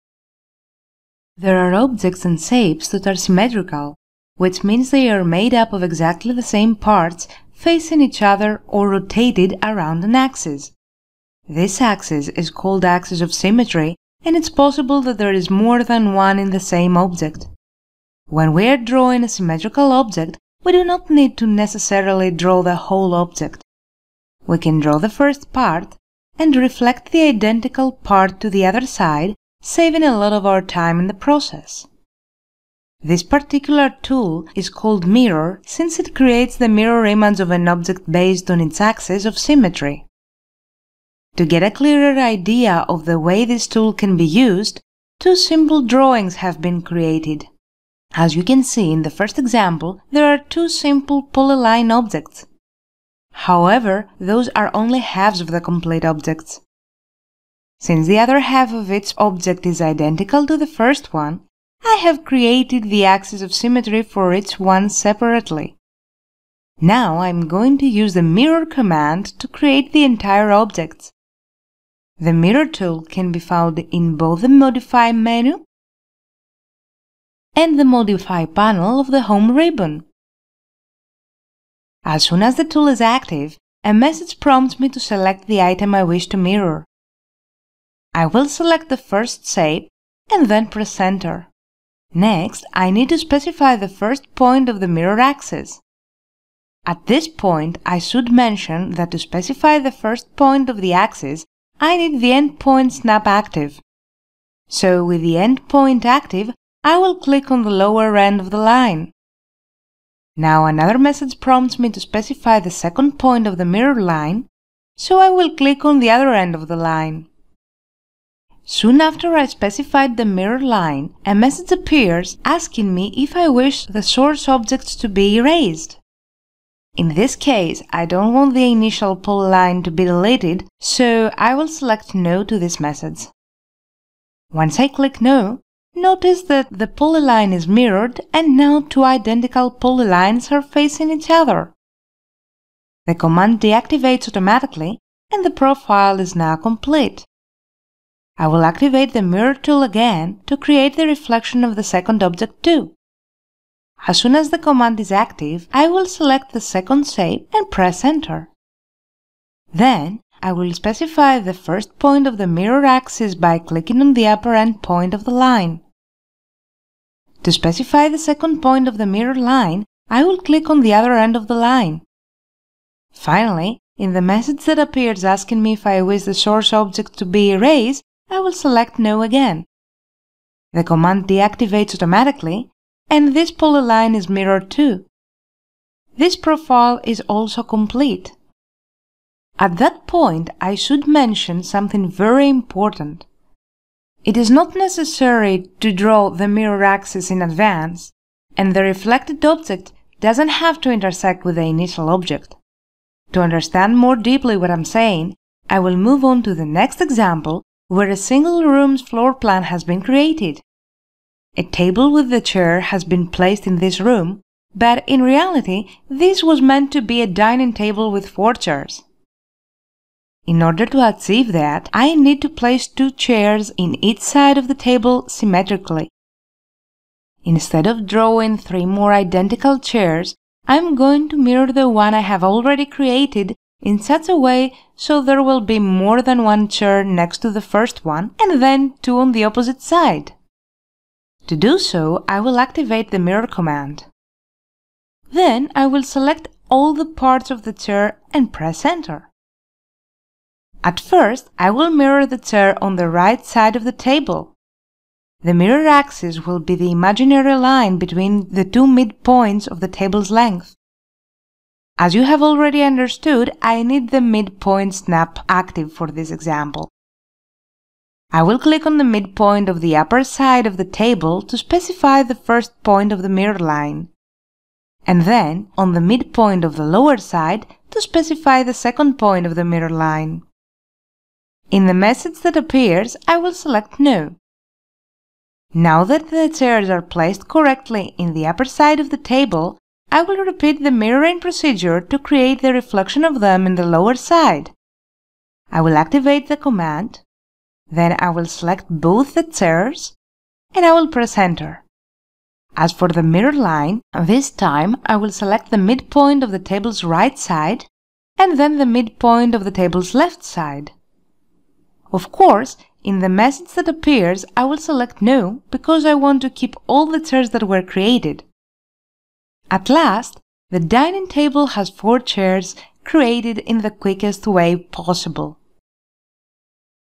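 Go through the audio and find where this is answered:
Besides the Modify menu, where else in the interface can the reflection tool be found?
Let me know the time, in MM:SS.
01:17.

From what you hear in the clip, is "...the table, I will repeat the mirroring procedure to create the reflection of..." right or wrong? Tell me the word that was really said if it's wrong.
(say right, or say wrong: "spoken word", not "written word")
right.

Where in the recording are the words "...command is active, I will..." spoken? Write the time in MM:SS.
02:34.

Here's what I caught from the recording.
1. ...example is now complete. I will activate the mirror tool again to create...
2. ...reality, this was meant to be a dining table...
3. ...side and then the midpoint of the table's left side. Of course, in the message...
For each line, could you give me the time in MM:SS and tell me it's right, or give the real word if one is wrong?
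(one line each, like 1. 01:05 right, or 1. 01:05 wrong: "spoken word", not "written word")
1. 02:25 wrong: "profile", not "example"
2. 03:35 right
3. 05:07 right.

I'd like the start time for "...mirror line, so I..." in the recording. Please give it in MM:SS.
01:53.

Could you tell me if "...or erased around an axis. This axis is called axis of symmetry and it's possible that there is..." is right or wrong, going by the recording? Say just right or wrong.
wrong.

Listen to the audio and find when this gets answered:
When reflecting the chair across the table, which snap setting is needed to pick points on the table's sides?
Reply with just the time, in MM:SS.
04:24.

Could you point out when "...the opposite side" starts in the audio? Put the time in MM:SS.
03:59.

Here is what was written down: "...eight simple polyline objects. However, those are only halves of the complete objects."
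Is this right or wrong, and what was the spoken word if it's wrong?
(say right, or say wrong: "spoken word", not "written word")
wrong: "two", not "eight".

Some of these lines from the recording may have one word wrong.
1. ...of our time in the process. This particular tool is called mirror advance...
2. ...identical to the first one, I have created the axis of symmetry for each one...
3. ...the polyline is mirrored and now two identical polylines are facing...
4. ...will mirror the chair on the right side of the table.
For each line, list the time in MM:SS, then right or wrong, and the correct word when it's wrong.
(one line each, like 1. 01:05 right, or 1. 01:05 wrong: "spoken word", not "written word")
1. 00:30 wrong: "since", not "advance"
2. 00:59 right
3. 02:16 right
4. 04:11 right.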